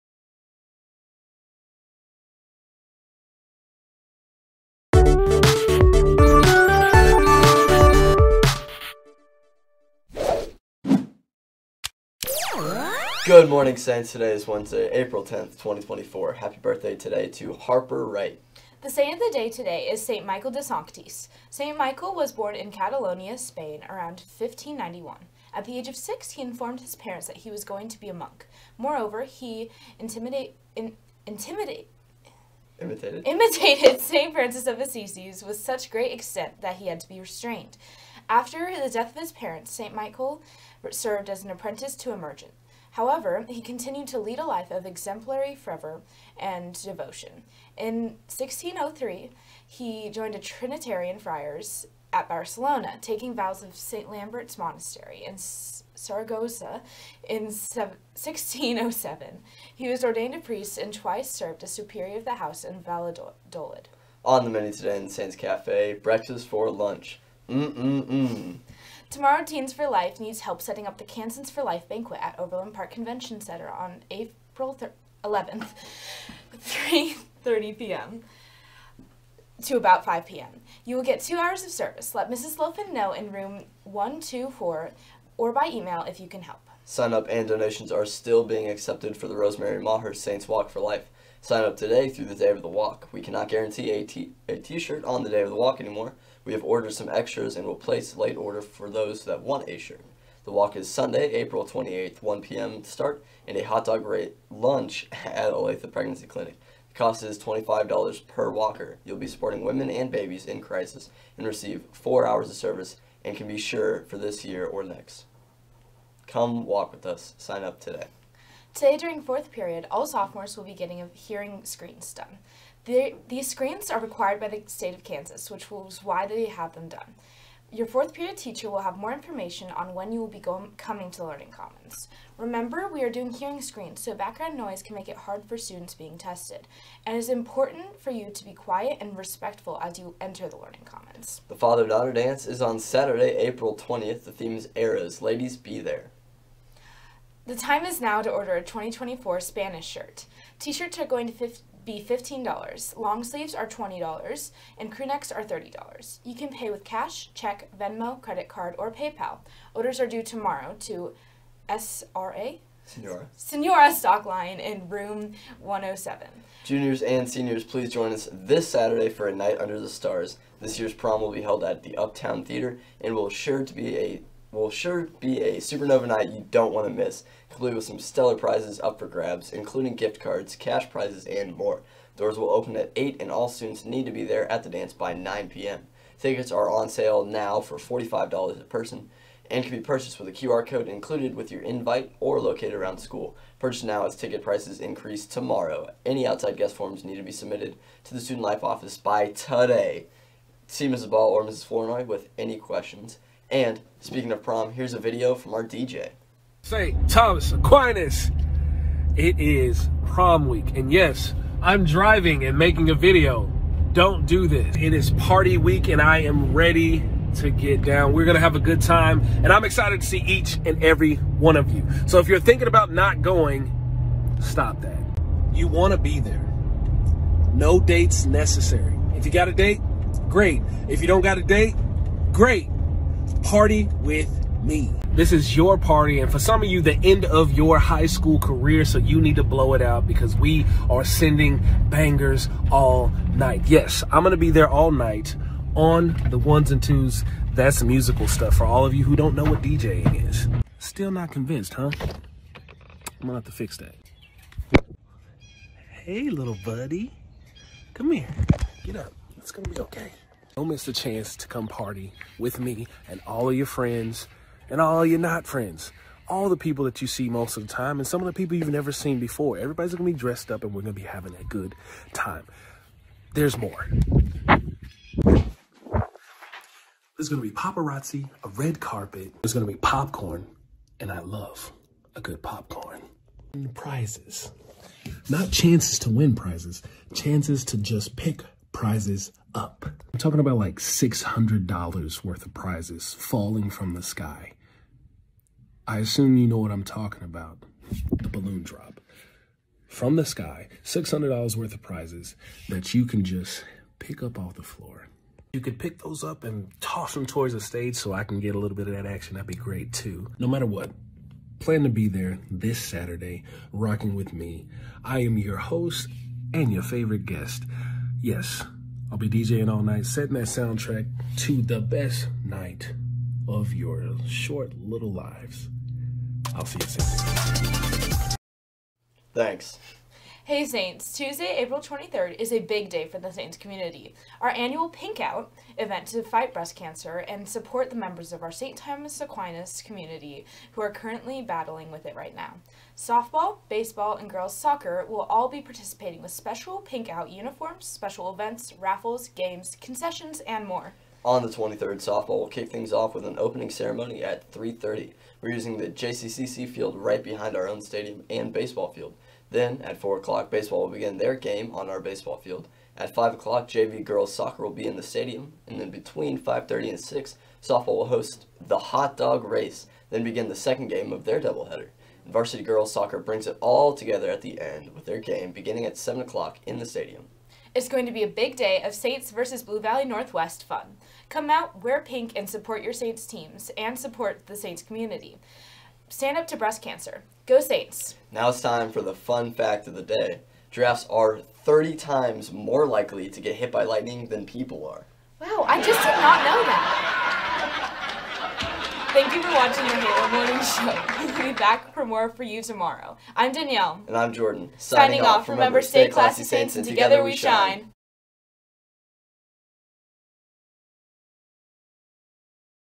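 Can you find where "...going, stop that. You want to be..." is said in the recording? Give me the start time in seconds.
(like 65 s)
223 s.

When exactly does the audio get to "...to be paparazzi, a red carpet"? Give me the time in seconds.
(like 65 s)
277 s.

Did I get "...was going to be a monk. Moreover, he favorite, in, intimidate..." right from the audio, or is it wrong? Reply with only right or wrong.
wrong.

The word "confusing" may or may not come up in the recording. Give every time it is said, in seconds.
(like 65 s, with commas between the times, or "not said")
not said.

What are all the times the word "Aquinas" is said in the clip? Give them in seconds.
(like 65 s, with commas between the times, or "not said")
207 s, 339 s.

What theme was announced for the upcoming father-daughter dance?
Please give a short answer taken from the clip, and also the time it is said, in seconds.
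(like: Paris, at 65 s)
Eras, at 144 s.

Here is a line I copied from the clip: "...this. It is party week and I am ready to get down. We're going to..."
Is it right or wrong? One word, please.
right.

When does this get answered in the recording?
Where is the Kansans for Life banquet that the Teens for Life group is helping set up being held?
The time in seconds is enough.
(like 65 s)
72 s.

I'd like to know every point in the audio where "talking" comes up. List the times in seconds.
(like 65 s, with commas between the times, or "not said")
290 s, 296 s.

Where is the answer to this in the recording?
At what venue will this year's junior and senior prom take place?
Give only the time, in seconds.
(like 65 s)
171 s.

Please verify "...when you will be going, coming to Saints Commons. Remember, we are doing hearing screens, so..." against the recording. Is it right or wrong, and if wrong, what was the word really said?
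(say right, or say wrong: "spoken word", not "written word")
wrong: "Learning", not "Saints".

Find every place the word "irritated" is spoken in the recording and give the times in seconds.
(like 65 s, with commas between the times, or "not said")
not said.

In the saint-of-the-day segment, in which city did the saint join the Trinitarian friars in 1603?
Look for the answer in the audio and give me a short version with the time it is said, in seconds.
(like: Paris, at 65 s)
Barcelona, at 52 s.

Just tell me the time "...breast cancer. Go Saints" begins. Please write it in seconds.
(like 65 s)
386 s.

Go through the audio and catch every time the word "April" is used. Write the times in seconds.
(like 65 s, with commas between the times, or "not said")
14 s, 74 s, 101 s, 143 s, 331 s.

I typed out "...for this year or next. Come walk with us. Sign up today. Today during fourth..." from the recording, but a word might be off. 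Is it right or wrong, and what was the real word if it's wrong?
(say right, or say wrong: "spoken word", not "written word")
right.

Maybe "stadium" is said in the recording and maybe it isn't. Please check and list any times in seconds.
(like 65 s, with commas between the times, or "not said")
357 s, 365 s, 376 s.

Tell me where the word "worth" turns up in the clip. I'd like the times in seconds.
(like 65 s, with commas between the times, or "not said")
292 s, 301 s.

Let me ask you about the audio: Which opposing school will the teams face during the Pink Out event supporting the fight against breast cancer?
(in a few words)
Blue Valley Northwest.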